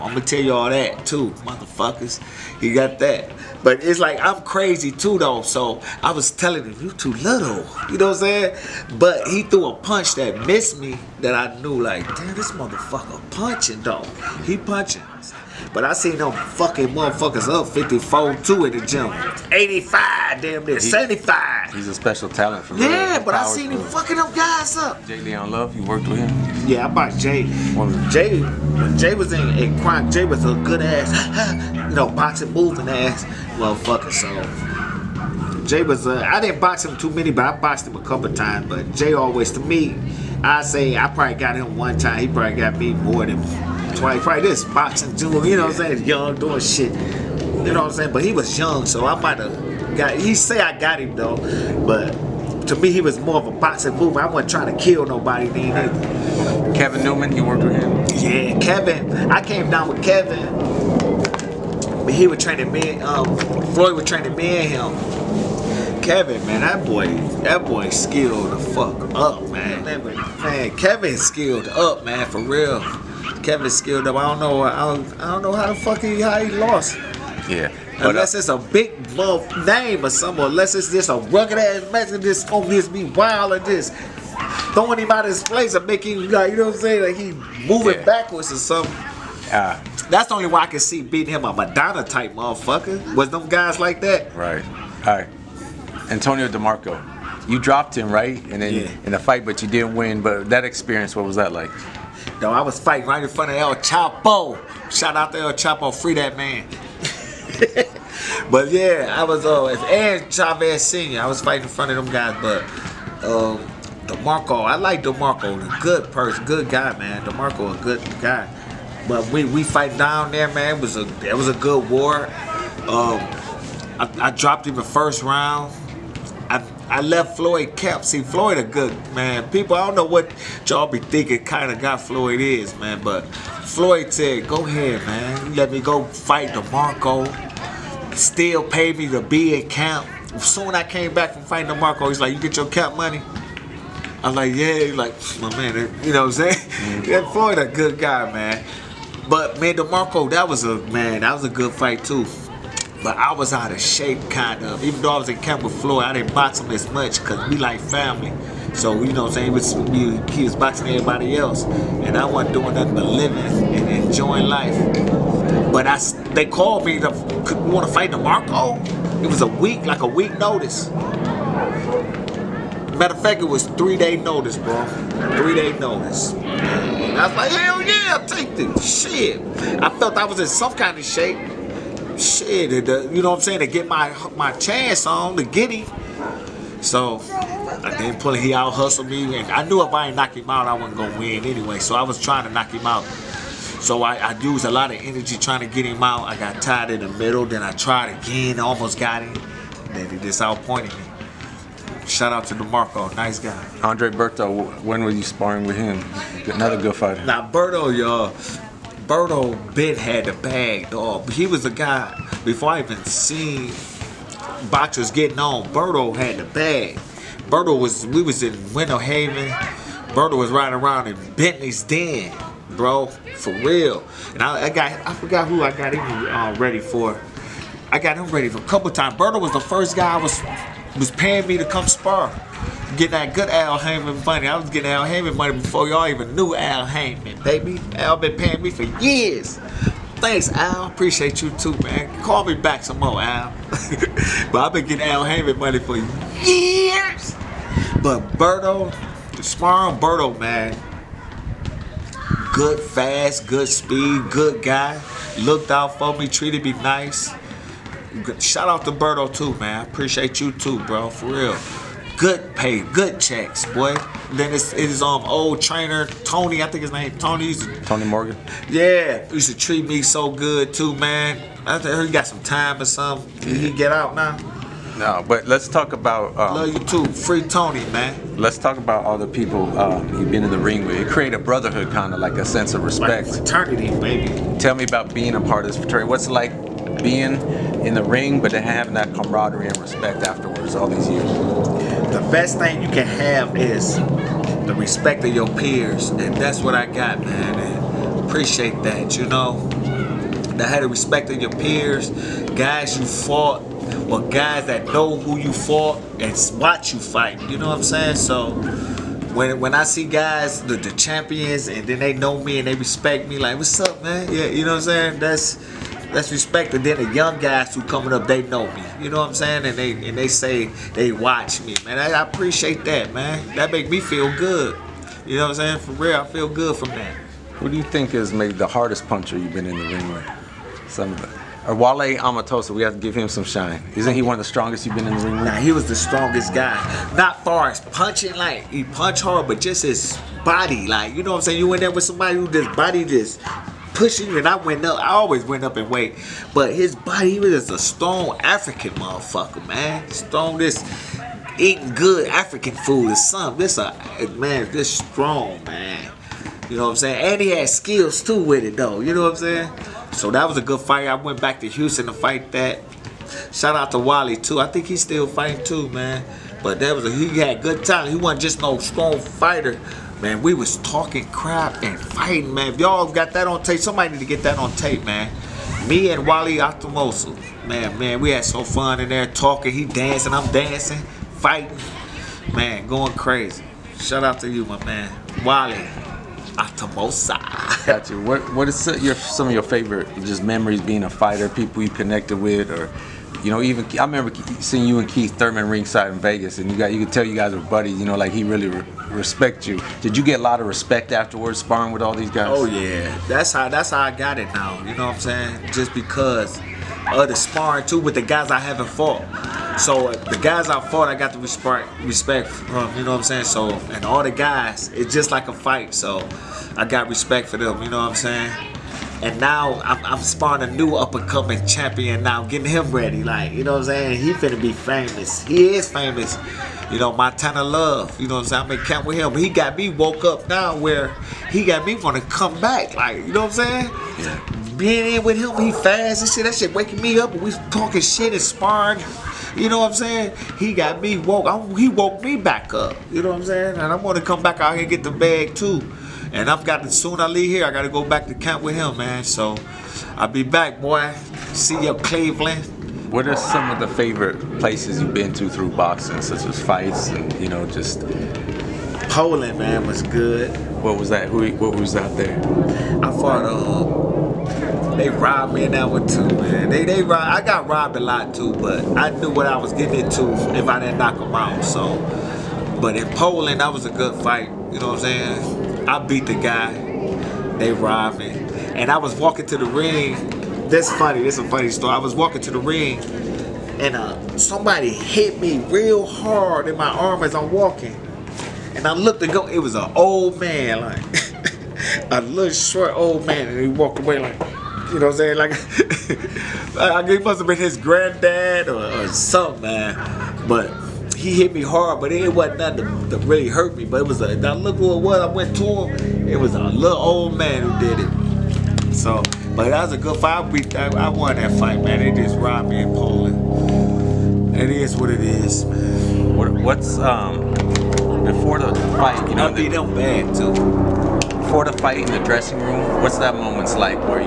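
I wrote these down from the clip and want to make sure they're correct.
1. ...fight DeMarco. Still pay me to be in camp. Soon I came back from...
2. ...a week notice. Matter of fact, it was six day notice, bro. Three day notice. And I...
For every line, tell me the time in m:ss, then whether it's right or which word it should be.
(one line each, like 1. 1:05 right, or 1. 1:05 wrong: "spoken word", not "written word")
1. 2:16 right
2. 2:50 wrong: "three", not "six".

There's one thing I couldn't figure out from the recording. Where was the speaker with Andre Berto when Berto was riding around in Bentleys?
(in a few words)
Winter Haven.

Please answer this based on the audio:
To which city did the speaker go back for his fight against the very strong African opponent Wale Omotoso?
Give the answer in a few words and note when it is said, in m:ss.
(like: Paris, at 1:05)
Houston, at 6:01.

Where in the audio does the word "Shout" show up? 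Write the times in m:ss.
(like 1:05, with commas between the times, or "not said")
1:44, 3:22, 4:18, 6:03, 6:23.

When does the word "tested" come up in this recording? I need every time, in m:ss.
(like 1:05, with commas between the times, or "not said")
not said.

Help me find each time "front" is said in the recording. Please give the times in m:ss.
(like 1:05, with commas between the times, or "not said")
1:43, 1:51.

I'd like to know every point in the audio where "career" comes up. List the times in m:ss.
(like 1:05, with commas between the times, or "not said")
not said.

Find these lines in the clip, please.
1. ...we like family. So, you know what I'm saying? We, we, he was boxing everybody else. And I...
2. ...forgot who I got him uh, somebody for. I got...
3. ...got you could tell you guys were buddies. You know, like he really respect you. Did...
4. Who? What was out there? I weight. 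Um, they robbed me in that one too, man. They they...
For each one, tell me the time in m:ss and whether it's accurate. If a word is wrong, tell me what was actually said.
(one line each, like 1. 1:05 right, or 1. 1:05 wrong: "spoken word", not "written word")
1. 2:37 right
2. 3:45 wrong: "ready", not "somebody"
3. 6:36 right
4. 7:41 wrong: "fought", not "weight".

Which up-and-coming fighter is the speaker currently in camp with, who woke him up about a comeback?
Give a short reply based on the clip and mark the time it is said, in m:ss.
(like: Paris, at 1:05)
Montana Love, at 7:07.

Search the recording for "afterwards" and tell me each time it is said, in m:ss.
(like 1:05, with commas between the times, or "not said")
4:50, 6:41.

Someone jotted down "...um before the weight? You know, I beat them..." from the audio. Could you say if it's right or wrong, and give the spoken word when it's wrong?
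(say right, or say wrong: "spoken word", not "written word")
wrong: "fight", not "weight".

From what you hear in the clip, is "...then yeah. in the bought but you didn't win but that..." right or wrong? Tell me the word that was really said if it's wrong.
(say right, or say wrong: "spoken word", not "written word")
wrong: "fight", not "bought".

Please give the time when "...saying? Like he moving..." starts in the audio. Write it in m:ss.
1:26.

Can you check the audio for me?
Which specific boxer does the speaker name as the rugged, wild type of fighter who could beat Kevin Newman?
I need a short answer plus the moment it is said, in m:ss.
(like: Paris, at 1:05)
Maidana, at 1:31.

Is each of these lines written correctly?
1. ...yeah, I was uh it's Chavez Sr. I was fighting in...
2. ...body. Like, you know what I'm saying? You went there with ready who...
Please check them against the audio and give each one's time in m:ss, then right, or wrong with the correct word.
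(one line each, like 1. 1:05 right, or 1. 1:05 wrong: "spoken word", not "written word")
1. 1:48 right
2. 5:40 wrong: "somebody", not "ready".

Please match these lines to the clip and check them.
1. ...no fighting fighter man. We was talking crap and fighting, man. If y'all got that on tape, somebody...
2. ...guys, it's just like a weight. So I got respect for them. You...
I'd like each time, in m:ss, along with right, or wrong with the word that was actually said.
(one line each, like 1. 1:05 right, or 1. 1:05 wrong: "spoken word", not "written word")
1. 6:08 wrong: "strong", not "fighting"
2. 6:54 wrong: "fight", not "weight".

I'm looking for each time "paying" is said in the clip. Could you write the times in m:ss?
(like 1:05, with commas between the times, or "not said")
3:51, 3:58.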